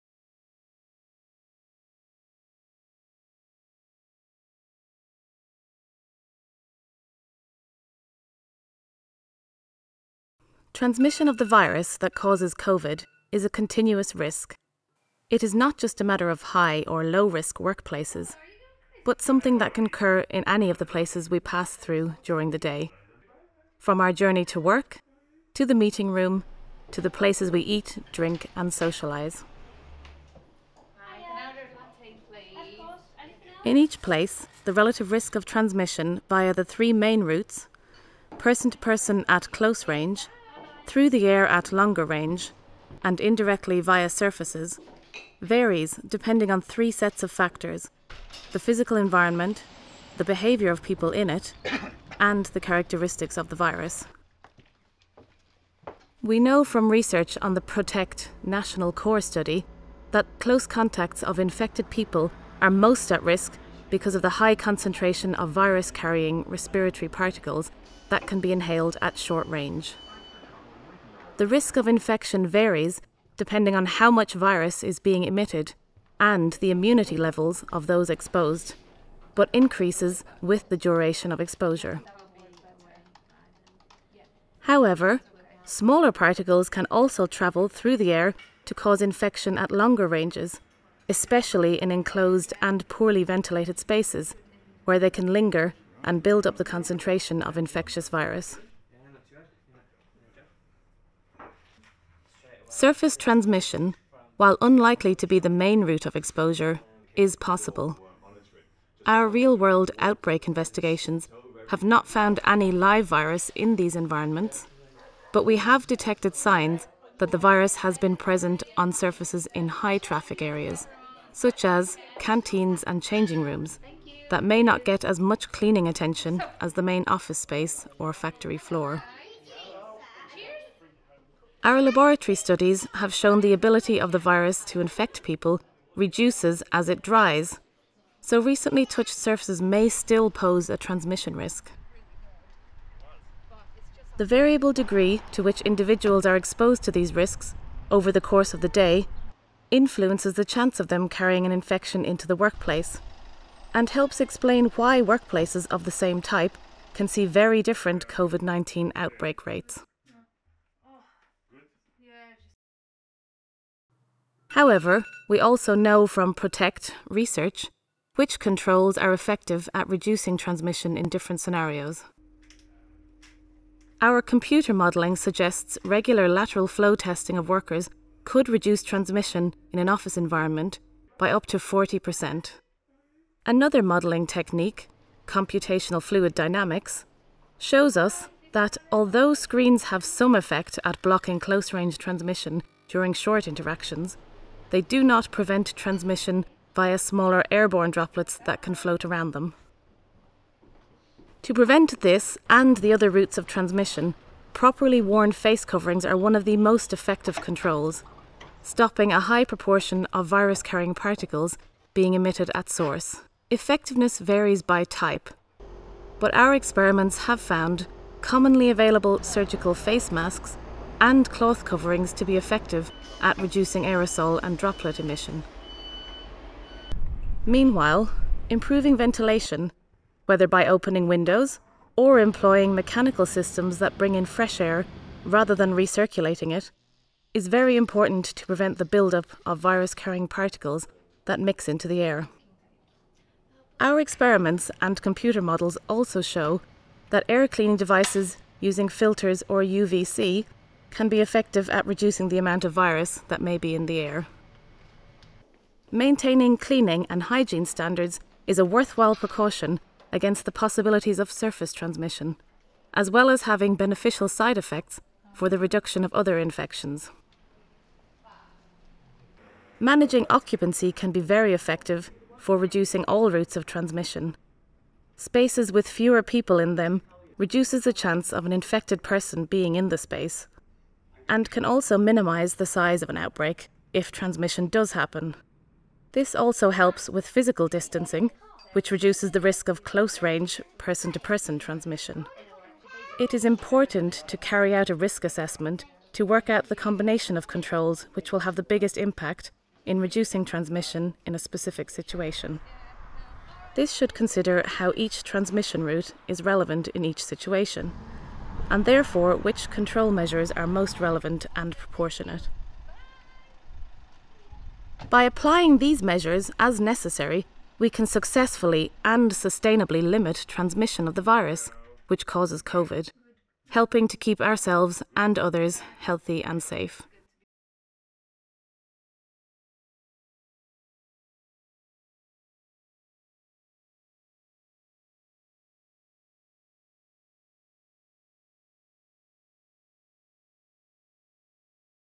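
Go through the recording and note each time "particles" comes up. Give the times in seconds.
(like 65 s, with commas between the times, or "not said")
67 s, 86 s, 210 s, 240 s.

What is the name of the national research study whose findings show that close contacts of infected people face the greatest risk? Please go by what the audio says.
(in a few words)
PROTECT National Core Study.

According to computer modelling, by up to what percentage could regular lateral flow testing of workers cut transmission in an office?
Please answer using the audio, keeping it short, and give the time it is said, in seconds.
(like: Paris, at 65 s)
40%, at 181 s.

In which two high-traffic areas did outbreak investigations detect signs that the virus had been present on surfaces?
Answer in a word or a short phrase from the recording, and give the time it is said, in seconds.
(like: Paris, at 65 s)
canteens and changing rooms, at 122 s.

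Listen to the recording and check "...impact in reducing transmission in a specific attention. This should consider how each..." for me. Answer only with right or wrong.
wrong.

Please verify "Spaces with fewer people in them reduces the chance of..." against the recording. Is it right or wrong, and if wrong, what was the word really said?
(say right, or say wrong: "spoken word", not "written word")
right.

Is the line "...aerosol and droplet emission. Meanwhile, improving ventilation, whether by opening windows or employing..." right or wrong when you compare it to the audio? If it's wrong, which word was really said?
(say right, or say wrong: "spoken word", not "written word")
right.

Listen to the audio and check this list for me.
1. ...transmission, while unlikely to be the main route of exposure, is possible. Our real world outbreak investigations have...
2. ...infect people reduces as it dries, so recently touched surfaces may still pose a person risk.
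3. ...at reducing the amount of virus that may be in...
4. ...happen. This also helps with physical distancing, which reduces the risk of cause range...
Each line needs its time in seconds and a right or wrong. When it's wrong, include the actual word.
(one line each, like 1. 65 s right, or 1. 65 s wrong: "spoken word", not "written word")
1. 103 s right
2. 134 s wrong: "transmission", not "person"
3. 251 s right
4. 284 s wrong: "close", not "cause".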